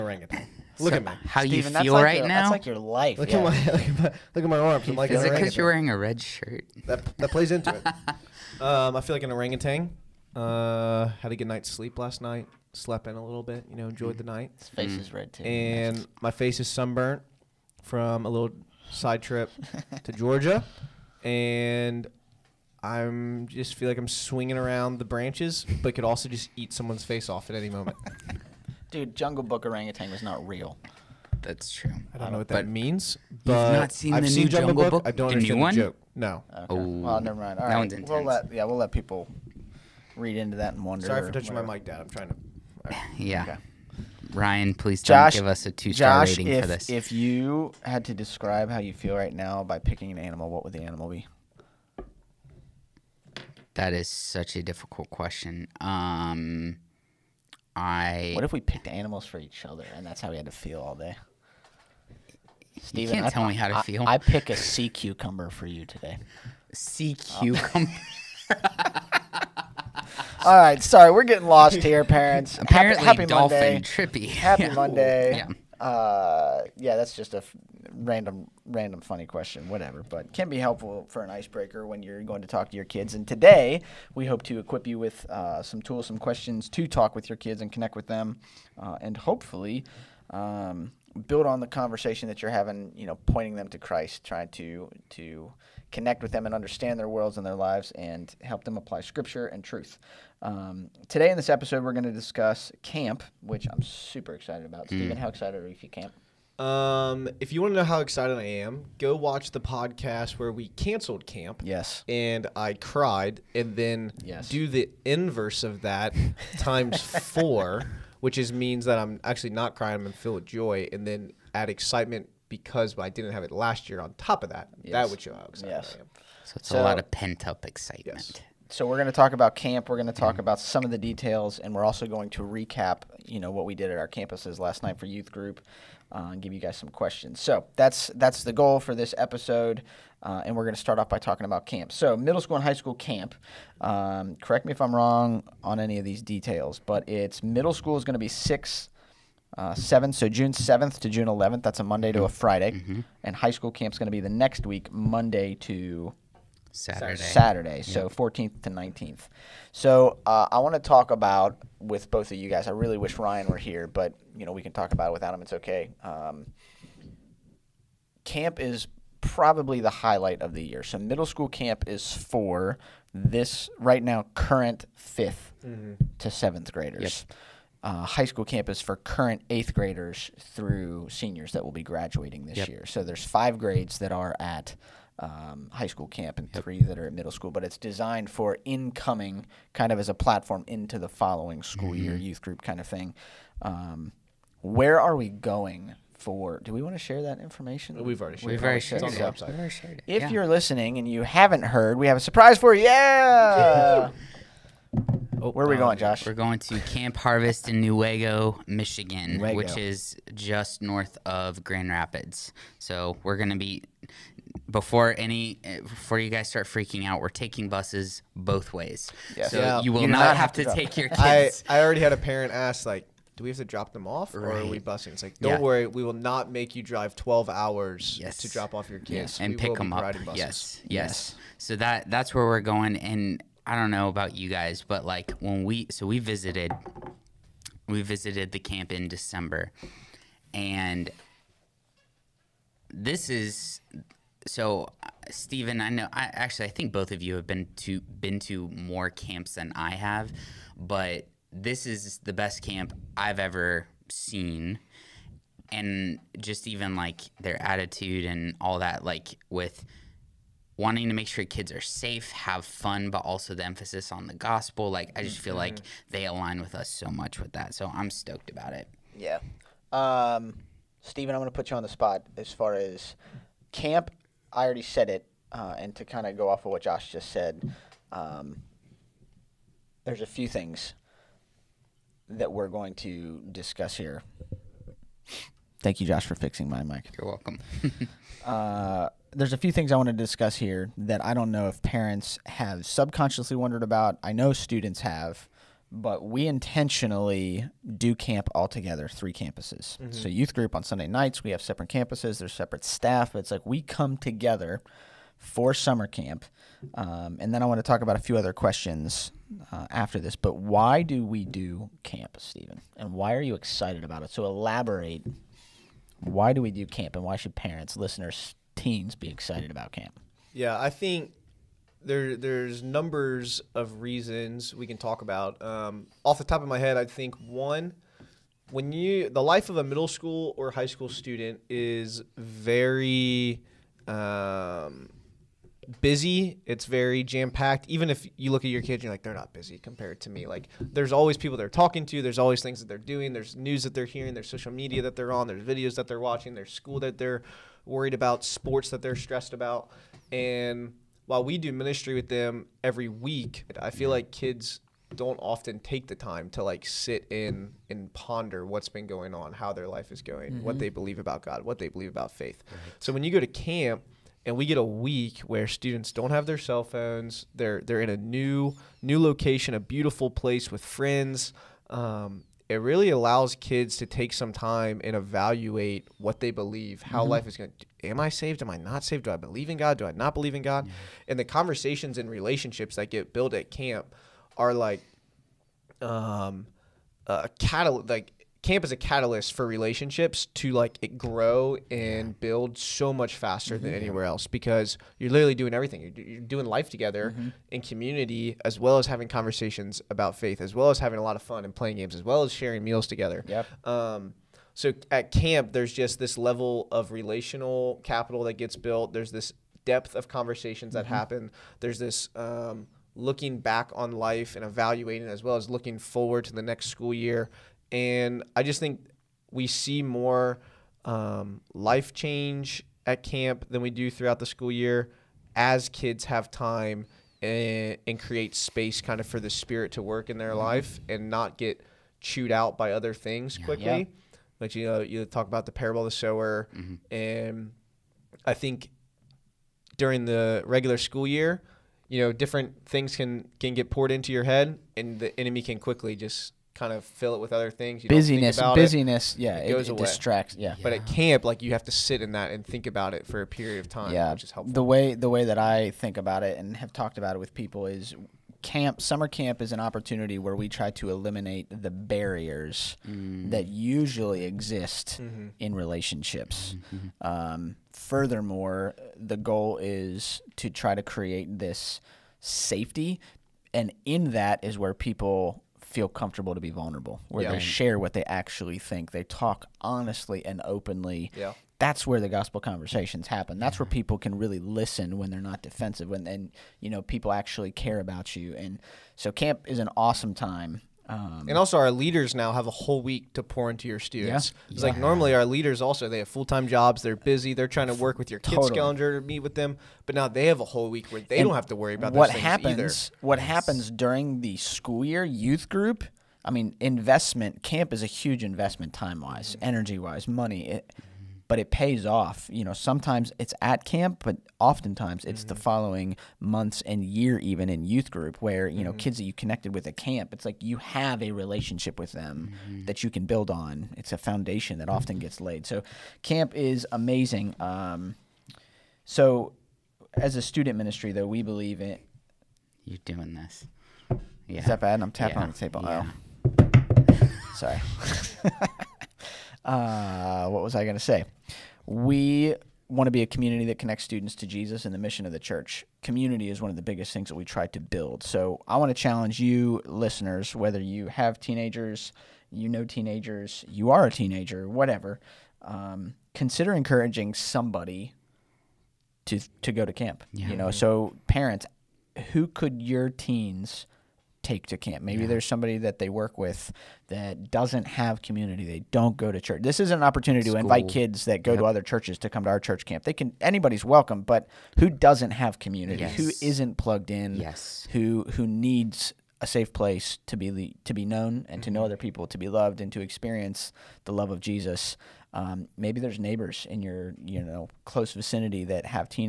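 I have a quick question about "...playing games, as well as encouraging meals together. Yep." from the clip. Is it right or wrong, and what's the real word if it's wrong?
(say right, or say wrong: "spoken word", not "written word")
wrong: "sharing", not "encouraging".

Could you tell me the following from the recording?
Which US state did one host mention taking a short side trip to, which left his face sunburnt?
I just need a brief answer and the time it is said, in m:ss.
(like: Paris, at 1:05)
Georgia, at 0:20.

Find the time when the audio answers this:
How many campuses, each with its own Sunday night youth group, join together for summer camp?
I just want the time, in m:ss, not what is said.
4:59.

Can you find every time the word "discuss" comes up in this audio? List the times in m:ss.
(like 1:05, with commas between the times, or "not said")
1:42, 4:43, 4:50.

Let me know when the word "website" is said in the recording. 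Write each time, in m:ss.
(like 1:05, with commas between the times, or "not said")
3:19.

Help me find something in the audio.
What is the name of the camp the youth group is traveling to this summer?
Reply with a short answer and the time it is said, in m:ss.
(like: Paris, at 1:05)
Camp Harvest, at 3:26.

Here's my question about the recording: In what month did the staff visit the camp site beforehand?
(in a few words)
December.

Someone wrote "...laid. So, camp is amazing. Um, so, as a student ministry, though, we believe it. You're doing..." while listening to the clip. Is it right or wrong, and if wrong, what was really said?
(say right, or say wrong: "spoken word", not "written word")
right.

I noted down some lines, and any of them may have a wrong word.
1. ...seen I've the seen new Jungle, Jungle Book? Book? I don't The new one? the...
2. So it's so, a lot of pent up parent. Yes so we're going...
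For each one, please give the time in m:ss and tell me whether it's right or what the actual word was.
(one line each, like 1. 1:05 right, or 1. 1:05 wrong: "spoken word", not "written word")
1. 0:33 right
2. 2:06 wrong: "excitement", not "parent".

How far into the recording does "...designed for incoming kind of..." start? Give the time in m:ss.
3:07.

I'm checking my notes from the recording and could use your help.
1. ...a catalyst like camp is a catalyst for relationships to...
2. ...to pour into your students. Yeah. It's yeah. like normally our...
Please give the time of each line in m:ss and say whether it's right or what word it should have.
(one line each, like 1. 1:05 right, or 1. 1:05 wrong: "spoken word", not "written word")
1. 6:27 right
2. 8:13 right.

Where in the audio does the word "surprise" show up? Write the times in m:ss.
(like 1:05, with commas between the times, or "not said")
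3:22.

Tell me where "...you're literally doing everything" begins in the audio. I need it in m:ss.
6:35.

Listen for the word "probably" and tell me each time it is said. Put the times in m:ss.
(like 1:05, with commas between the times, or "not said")
2:49.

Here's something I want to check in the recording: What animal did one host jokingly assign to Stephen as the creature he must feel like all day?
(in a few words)
Sea cucumber.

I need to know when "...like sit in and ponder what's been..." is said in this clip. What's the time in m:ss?
5:56.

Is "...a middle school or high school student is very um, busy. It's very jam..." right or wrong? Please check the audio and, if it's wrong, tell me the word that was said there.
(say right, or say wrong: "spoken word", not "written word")
right.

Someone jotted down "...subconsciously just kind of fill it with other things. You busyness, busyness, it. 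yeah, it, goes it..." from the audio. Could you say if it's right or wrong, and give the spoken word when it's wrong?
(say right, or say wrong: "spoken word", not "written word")
wrong: "quickly", not "subconsciously".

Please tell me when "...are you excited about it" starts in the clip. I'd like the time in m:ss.
5:13.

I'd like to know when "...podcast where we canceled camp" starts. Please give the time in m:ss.
1:49.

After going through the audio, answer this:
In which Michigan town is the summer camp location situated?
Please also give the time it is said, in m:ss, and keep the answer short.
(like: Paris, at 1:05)
Newaygo, at 3:27.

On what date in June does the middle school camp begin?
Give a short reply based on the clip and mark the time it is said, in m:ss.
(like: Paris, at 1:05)
June 7th, at 2:30.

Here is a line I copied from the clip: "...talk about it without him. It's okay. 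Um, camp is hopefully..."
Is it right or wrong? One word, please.
wrong.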